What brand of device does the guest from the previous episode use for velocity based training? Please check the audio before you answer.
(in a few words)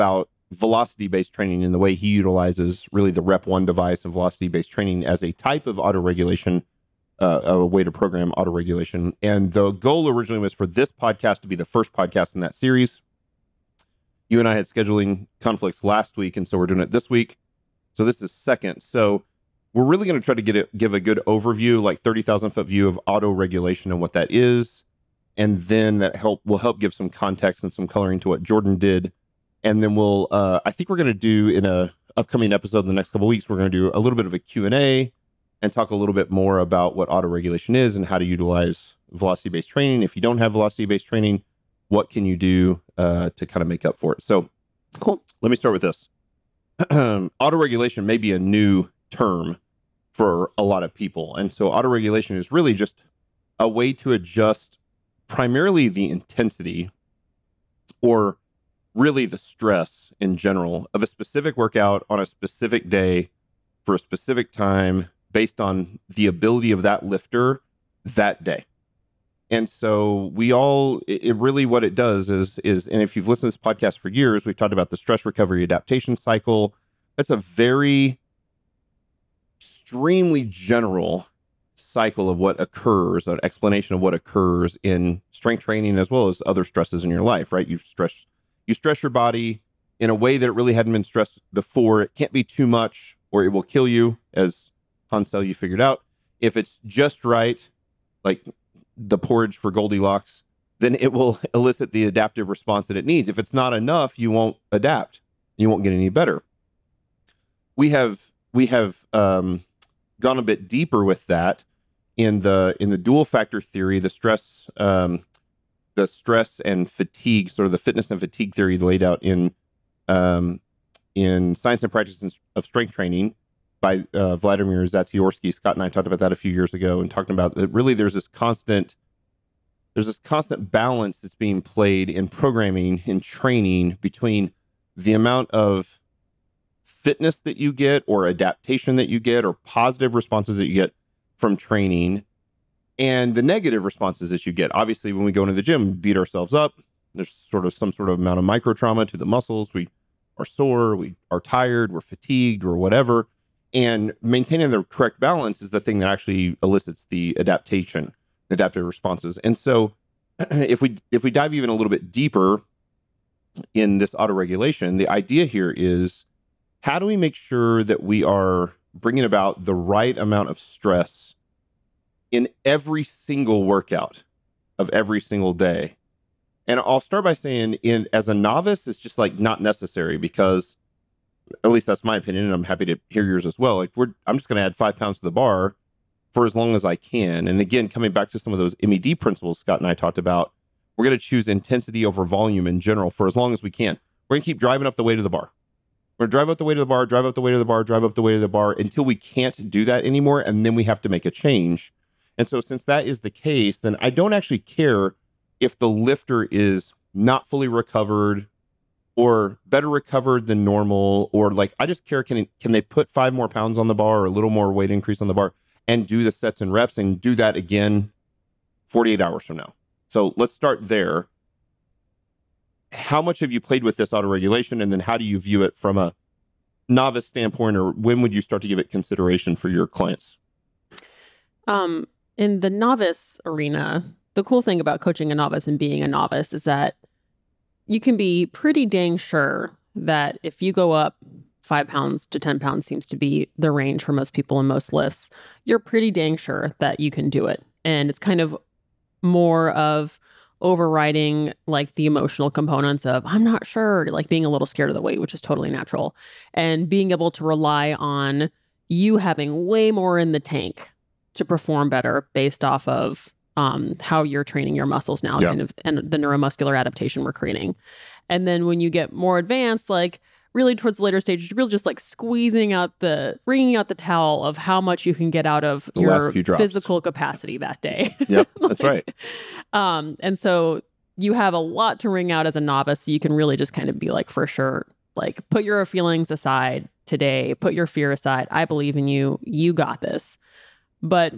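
RepOne.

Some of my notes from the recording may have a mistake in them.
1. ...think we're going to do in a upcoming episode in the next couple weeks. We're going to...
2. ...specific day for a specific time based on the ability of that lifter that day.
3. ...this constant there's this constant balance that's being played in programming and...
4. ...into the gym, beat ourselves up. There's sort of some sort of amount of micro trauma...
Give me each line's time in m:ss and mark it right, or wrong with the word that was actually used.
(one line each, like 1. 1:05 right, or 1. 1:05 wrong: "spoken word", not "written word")
1. 0:30 right
2. 1:02 right
3. 2:08 right
4. 2:25 right.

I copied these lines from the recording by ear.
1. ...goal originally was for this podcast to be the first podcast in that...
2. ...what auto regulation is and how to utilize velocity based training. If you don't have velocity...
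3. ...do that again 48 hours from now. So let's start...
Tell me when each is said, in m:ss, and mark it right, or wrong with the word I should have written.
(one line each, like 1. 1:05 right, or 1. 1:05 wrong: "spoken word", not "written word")
1. 0:09 right
2. 0:36 right
3. 3:37 right.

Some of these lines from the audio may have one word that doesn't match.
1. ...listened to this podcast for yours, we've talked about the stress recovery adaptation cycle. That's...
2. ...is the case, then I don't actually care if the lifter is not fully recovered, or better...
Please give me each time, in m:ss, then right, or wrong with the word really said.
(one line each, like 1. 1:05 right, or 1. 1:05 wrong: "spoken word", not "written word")
1. 1:13 wrong: "years", not "yours"
2. 3:23 right.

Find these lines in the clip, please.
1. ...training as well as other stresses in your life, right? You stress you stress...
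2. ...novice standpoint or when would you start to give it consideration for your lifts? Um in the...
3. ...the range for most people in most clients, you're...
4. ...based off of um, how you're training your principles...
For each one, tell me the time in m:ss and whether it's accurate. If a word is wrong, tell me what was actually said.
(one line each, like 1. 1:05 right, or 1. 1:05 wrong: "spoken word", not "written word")
1. 1:25 right
2. 3:46 wrong: "clients", not "lifts"
3. 4:03 wrong: "lifts", not "clients"
4. 4:22 wrong: "muscles", not "principles".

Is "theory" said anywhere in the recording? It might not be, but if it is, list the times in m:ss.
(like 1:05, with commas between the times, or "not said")
1:53, 1:58.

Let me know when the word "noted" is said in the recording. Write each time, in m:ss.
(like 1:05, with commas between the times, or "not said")
not said.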